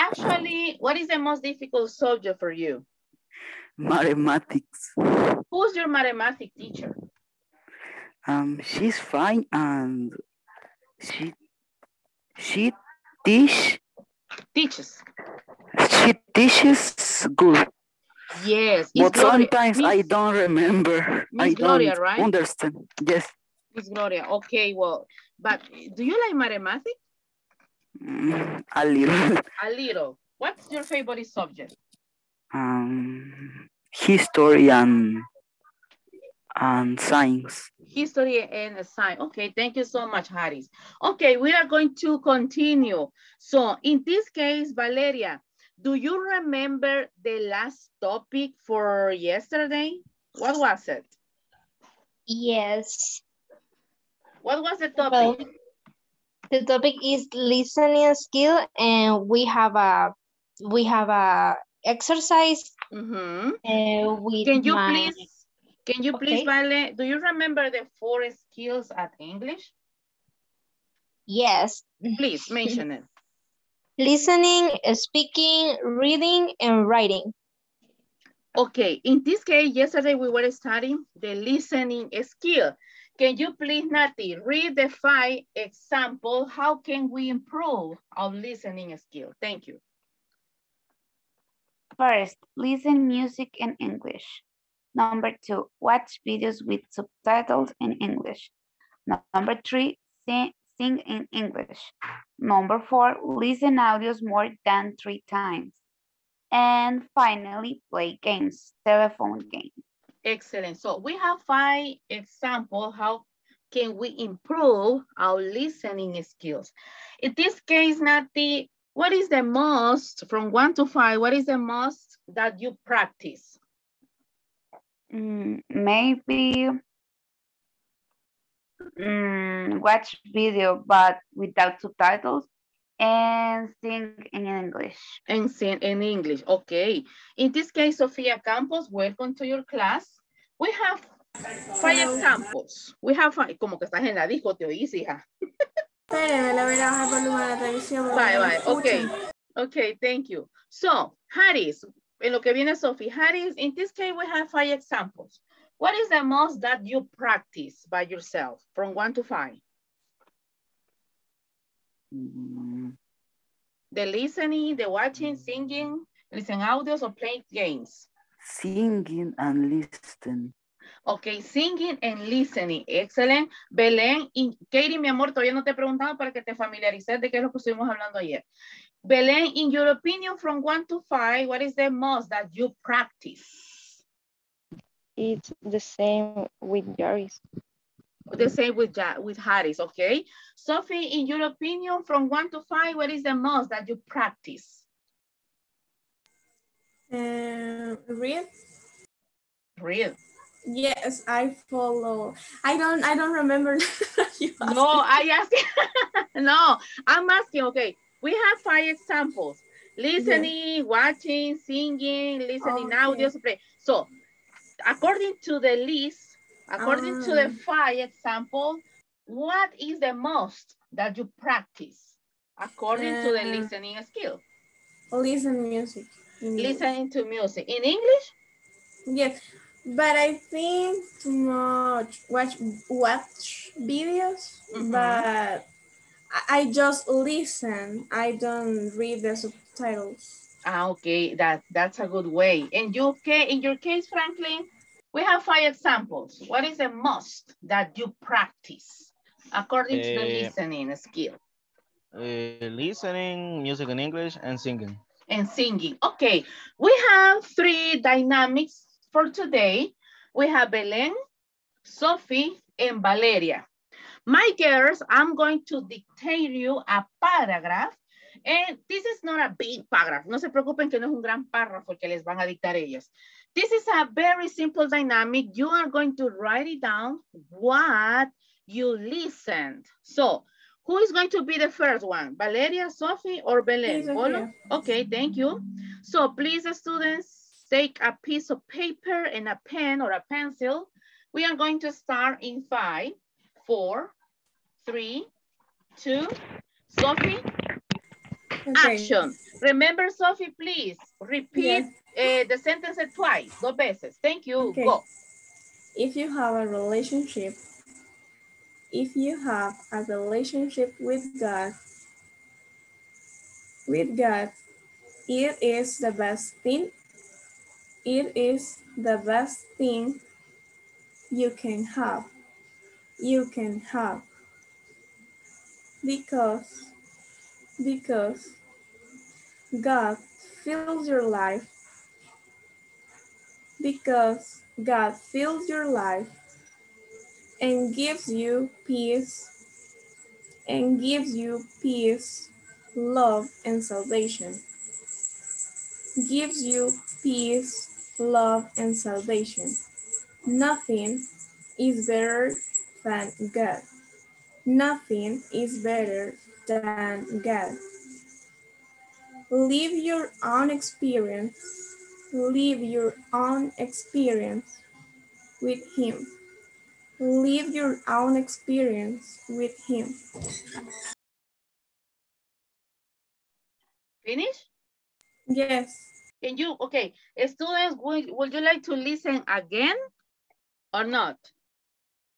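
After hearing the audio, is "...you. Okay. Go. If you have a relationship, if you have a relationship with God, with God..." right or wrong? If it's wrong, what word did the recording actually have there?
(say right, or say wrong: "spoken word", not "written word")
right.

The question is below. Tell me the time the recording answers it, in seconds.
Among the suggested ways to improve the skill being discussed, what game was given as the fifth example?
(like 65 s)
108 s.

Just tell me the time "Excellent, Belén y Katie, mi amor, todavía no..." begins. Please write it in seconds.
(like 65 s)
172 s.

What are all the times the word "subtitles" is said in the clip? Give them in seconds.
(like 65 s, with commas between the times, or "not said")
96 s, 131 s, 239 s.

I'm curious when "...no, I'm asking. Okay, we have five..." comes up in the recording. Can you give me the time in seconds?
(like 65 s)
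206 s.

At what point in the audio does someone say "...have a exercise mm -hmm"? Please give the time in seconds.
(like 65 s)
60 s.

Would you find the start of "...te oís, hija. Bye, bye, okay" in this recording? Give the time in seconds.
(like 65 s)
144 s.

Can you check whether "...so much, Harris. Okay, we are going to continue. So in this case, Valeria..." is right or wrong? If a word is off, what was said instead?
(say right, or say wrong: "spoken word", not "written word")
right.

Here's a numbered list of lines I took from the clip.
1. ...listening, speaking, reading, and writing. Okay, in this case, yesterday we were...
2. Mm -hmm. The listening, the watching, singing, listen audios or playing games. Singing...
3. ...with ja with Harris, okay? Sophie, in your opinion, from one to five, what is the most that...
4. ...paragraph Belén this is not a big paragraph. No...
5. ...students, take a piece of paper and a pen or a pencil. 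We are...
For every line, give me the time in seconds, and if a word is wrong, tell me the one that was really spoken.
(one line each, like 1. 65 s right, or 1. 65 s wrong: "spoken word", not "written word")
1. 73 s right
2. 162 s right
3. 188 s right
4. 267 s wrong: "And", not "Belén"
5. 286 s right.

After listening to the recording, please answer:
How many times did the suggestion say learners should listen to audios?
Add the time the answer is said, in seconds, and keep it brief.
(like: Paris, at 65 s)
More than 3 times, at 104 s.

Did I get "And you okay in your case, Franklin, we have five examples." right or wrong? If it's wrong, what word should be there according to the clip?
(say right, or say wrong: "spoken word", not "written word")
right.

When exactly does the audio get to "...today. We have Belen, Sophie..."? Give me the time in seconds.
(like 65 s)
259 s.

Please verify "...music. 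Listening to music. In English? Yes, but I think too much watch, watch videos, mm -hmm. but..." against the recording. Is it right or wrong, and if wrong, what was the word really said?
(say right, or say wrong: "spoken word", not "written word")
right.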